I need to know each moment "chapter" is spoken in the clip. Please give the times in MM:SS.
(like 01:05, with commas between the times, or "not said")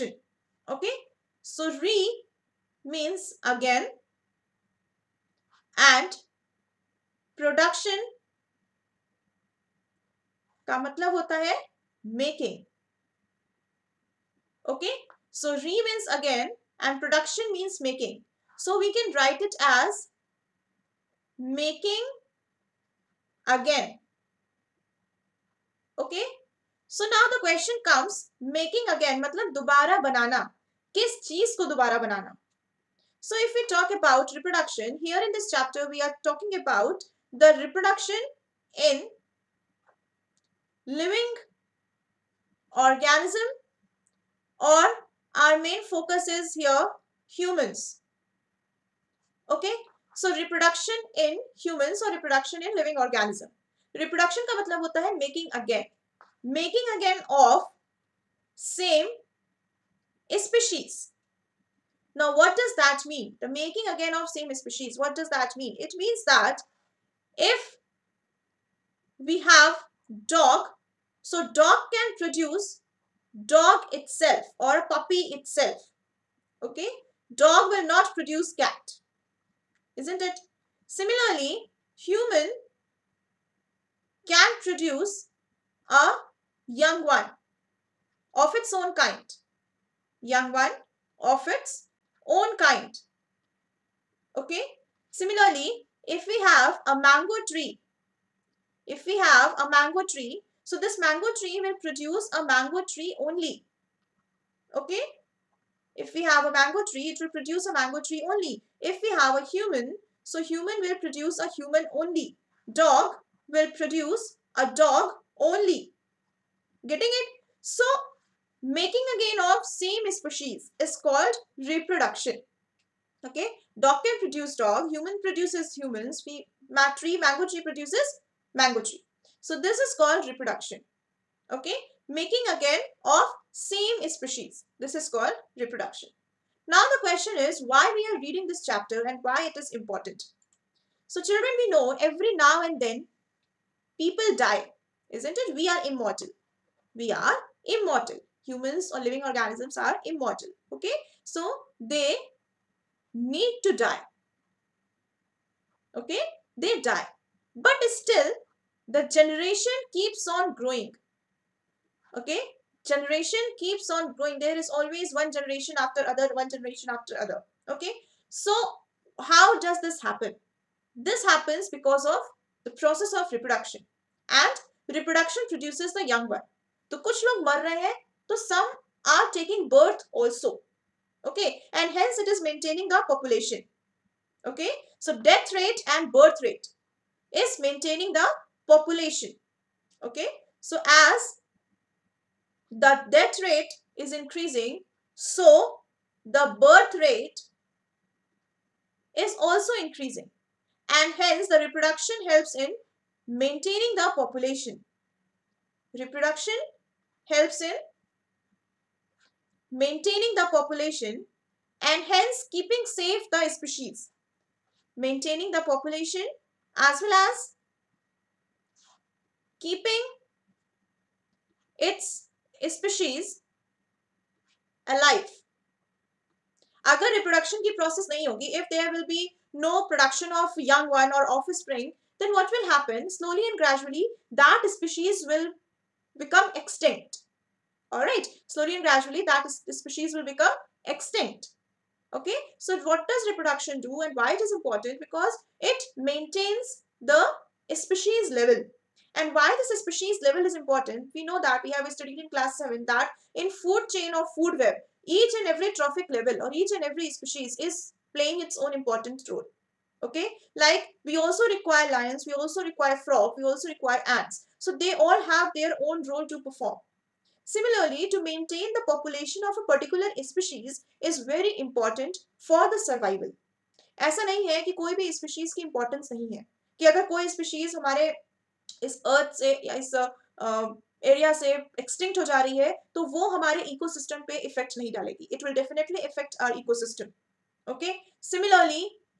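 00:35, 02:18.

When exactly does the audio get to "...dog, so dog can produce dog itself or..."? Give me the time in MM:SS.
01:10.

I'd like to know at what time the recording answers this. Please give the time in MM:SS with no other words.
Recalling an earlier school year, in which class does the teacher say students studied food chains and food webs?
04:12.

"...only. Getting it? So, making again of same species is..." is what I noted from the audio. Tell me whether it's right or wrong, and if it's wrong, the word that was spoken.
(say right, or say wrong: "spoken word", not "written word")
right.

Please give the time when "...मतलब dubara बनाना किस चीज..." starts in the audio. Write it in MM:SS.
00:29.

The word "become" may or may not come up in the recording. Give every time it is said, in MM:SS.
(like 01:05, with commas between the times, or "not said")
03:56, 04:00.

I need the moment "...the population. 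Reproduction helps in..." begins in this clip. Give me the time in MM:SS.
03:23.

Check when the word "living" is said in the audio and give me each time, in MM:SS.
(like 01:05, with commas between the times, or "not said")
00:40, 00:52, 02:28.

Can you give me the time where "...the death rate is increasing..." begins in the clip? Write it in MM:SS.
03:12.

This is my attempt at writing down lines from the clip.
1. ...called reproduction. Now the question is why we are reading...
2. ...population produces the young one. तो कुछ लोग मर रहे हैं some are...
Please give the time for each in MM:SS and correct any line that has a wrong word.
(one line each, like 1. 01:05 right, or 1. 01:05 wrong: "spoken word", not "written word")
1. 02:15 right
2. 02:54 wrong: "reproduction", not "population".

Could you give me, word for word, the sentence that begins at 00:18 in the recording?
So we can write it as making again.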